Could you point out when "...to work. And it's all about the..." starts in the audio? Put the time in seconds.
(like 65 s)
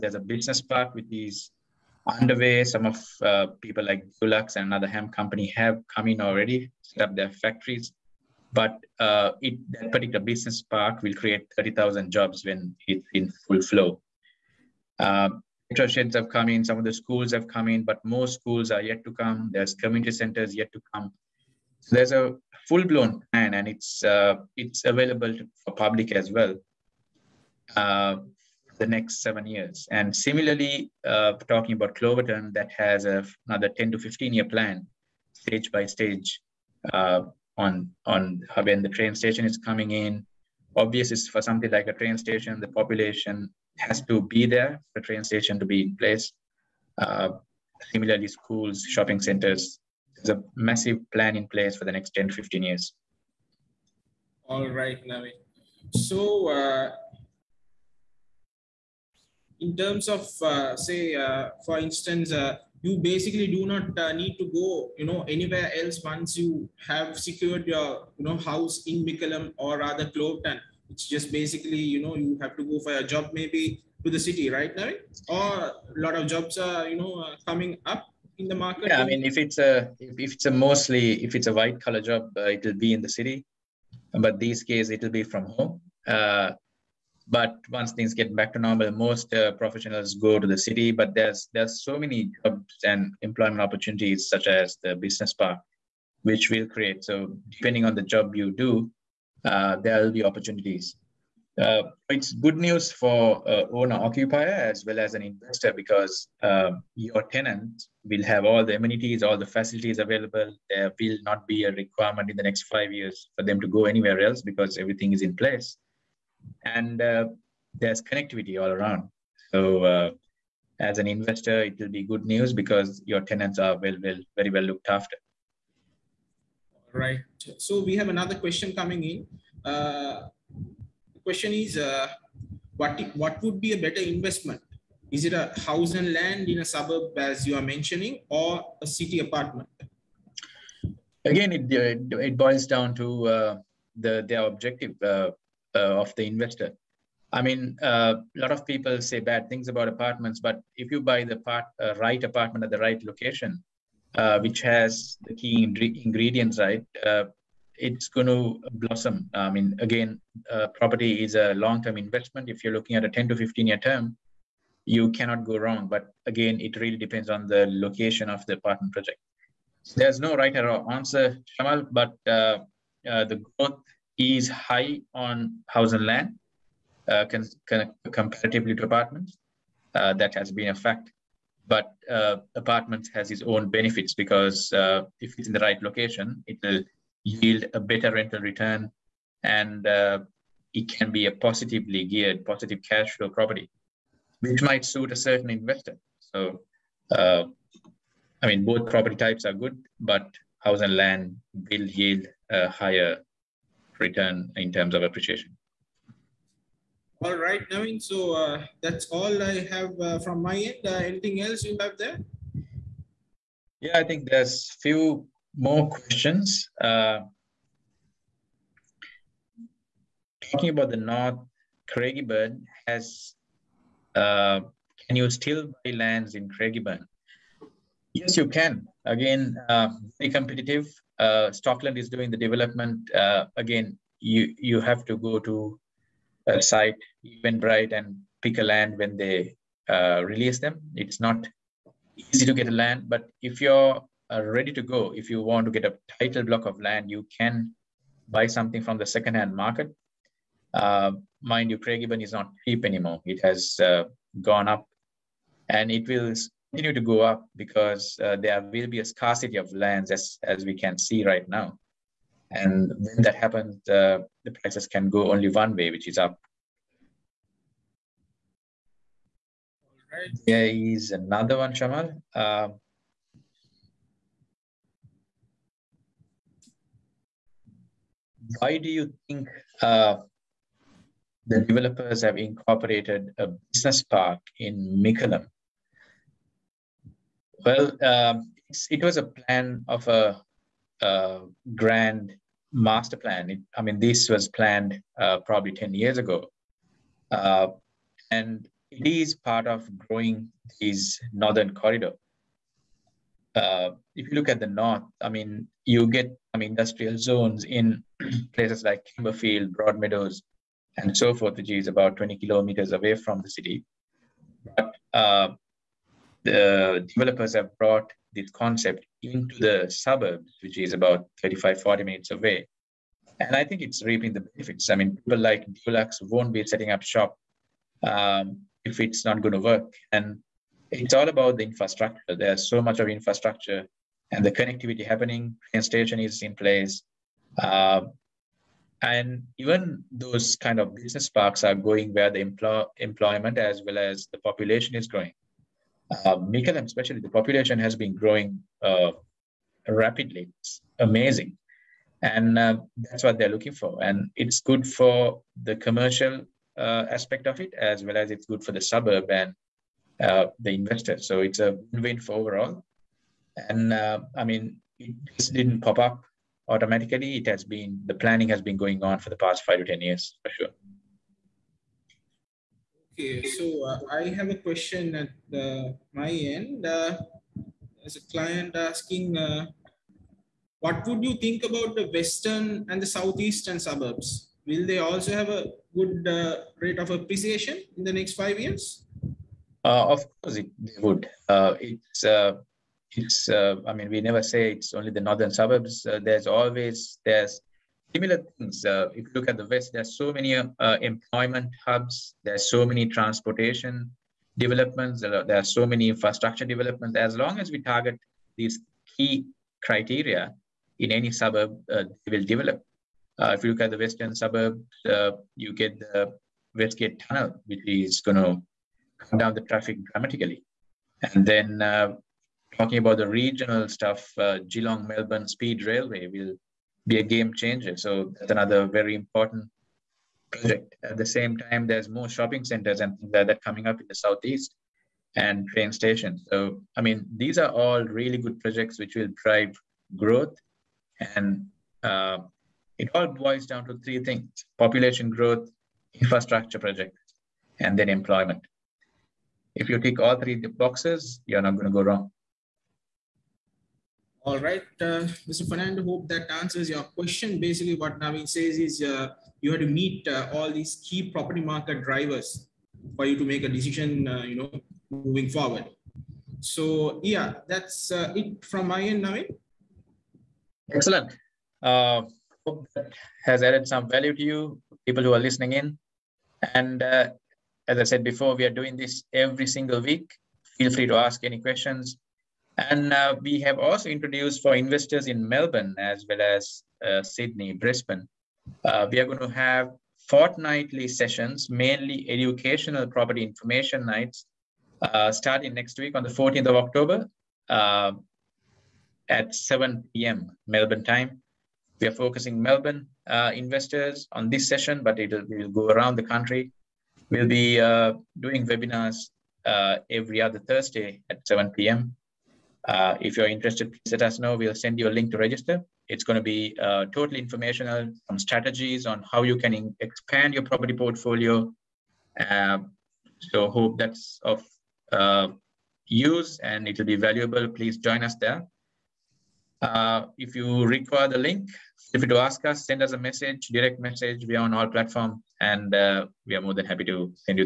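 329 s.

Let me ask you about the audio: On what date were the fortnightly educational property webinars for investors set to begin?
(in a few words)
14 October.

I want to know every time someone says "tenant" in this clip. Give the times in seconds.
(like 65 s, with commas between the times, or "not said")
107 s, 123 s.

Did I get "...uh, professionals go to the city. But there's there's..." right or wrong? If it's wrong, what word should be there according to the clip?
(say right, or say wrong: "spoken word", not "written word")
right.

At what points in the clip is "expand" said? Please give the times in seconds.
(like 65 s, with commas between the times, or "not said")
520 s.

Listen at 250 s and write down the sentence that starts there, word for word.
Uh, mind you, Craigieburn is not cheap anymore.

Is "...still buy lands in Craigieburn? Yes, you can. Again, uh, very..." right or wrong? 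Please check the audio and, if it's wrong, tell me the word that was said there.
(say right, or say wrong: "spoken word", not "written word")
right.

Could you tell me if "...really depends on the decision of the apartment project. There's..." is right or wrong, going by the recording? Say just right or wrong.
wrong.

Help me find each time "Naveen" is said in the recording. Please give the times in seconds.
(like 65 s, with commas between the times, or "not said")
207 s, 458 s, 469 s.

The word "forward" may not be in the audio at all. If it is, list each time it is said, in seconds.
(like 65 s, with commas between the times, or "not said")
465 s.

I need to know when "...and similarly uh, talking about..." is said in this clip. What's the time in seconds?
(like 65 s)
29 s.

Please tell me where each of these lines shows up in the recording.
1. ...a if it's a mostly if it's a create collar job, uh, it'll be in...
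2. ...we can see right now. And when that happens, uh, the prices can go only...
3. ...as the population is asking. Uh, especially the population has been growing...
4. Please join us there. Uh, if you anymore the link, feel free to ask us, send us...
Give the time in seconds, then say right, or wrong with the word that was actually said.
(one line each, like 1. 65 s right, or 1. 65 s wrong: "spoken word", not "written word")
1. 79 s wrong: "white", not "create"
2. 260 s right
3. 343 s wrong: "growing", not "asking"
4. 527 s wrong: "require", not "anymore".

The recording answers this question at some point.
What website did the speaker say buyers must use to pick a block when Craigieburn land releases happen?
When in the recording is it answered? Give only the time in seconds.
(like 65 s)
237 s.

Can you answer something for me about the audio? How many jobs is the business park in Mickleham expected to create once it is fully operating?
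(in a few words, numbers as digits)
30,000.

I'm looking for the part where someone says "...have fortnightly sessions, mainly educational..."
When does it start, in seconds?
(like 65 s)
489 s.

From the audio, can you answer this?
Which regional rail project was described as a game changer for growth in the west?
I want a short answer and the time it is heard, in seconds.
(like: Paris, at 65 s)
Geelong Melbourne Speed Railway, at 424 s.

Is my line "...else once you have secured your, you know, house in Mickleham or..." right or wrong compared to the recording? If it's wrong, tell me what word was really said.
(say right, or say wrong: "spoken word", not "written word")
right.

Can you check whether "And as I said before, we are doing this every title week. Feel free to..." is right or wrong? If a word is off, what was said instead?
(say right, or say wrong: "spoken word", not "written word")
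wrong: "single", not "title".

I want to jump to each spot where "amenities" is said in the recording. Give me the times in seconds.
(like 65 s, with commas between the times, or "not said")
108 s.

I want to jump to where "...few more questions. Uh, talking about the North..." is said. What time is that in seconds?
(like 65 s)
214 s.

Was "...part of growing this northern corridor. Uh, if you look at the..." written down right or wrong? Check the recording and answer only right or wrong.
right.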